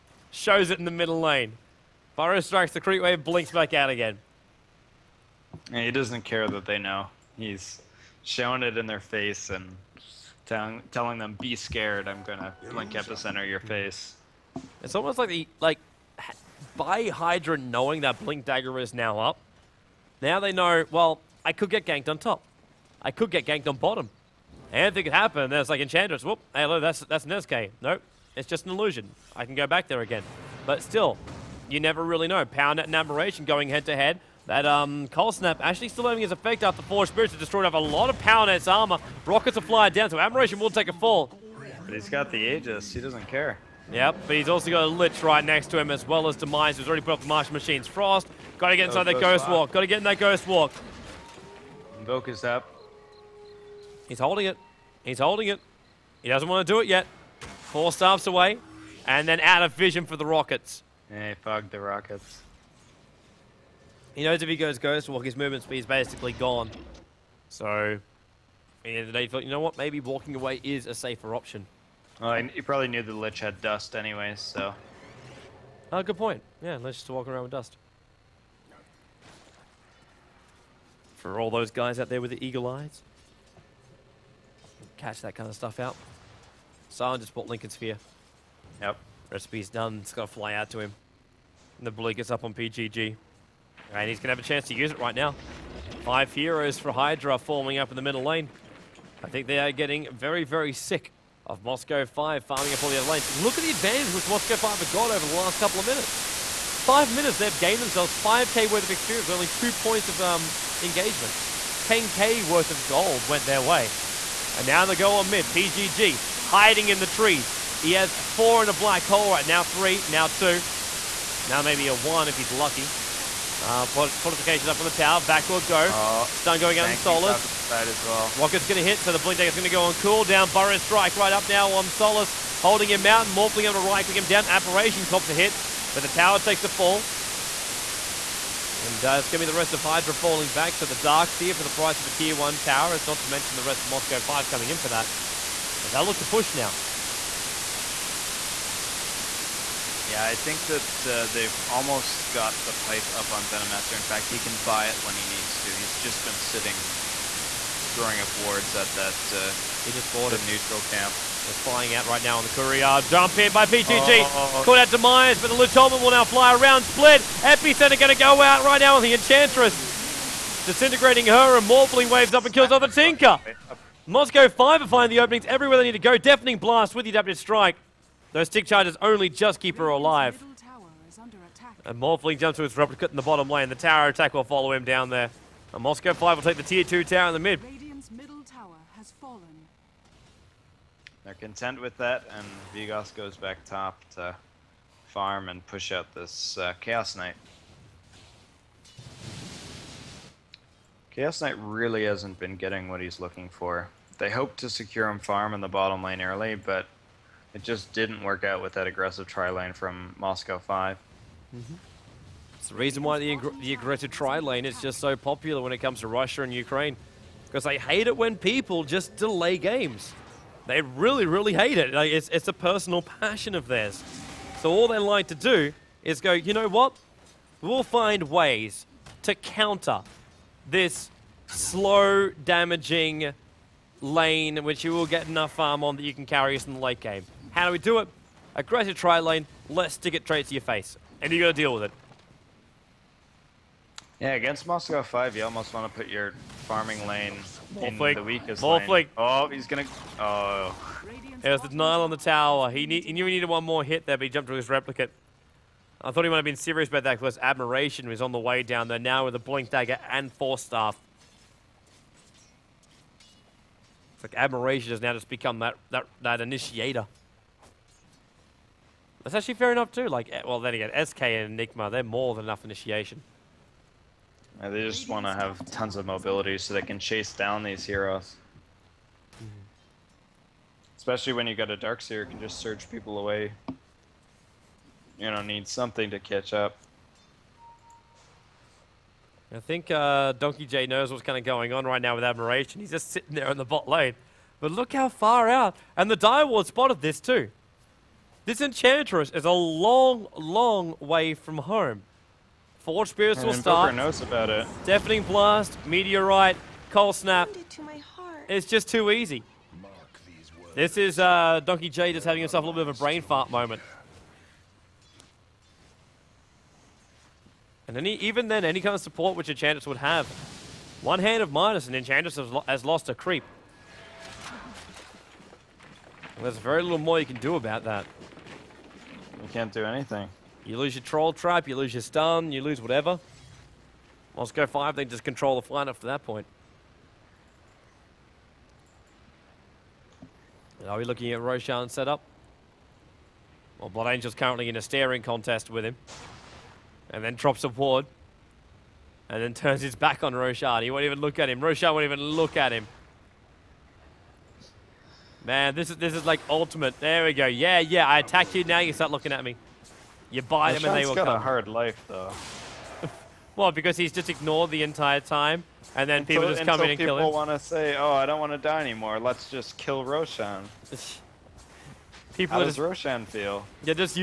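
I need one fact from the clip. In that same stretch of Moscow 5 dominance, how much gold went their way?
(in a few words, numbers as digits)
10k.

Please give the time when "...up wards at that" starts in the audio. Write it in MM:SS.
02:38.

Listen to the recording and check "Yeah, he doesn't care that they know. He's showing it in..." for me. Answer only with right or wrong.
right.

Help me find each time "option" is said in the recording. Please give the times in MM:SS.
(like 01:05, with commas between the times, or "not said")
01:11.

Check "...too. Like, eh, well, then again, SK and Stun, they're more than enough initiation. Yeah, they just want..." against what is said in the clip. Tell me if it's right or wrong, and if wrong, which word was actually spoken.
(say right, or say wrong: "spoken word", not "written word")
wrong: "Enigma", not "Stun".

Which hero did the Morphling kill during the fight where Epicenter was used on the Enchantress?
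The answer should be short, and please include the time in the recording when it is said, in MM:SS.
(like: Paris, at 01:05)
Tinker, at 02:52.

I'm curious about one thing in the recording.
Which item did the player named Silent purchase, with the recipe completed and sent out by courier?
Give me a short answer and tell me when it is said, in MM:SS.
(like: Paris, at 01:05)
Linken Sphere, at 01:27.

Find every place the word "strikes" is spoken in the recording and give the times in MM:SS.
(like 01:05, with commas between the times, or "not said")
00:02, 02:10, 02:57.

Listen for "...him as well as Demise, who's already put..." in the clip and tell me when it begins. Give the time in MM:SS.
00:45.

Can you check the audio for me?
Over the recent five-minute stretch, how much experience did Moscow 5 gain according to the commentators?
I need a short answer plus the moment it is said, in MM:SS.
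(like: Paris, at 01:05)
5k, at 01:48.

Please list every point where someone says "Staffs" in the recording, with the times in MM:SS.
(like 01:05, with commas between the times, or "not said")
00:57, 04:20.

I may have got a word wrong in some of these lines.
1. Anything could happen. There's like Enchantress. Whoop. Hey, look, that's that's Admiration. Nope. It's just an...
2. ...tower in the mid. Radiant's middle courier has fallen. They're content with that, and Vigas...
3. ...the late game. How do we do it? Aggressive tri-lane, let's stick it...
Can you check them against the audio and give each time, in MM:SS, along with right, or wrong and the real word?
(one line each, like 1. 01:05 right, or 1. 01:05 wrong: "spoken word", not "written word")
1. 00:24 wrong: "Nezuke", not "Admiration"
2. 03:07 wrong: "tower", not "courier"
3. 03:56 right.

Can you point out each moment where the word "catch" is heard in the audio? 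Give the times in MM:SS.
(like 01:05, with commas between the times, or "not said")
01:24, 04:46.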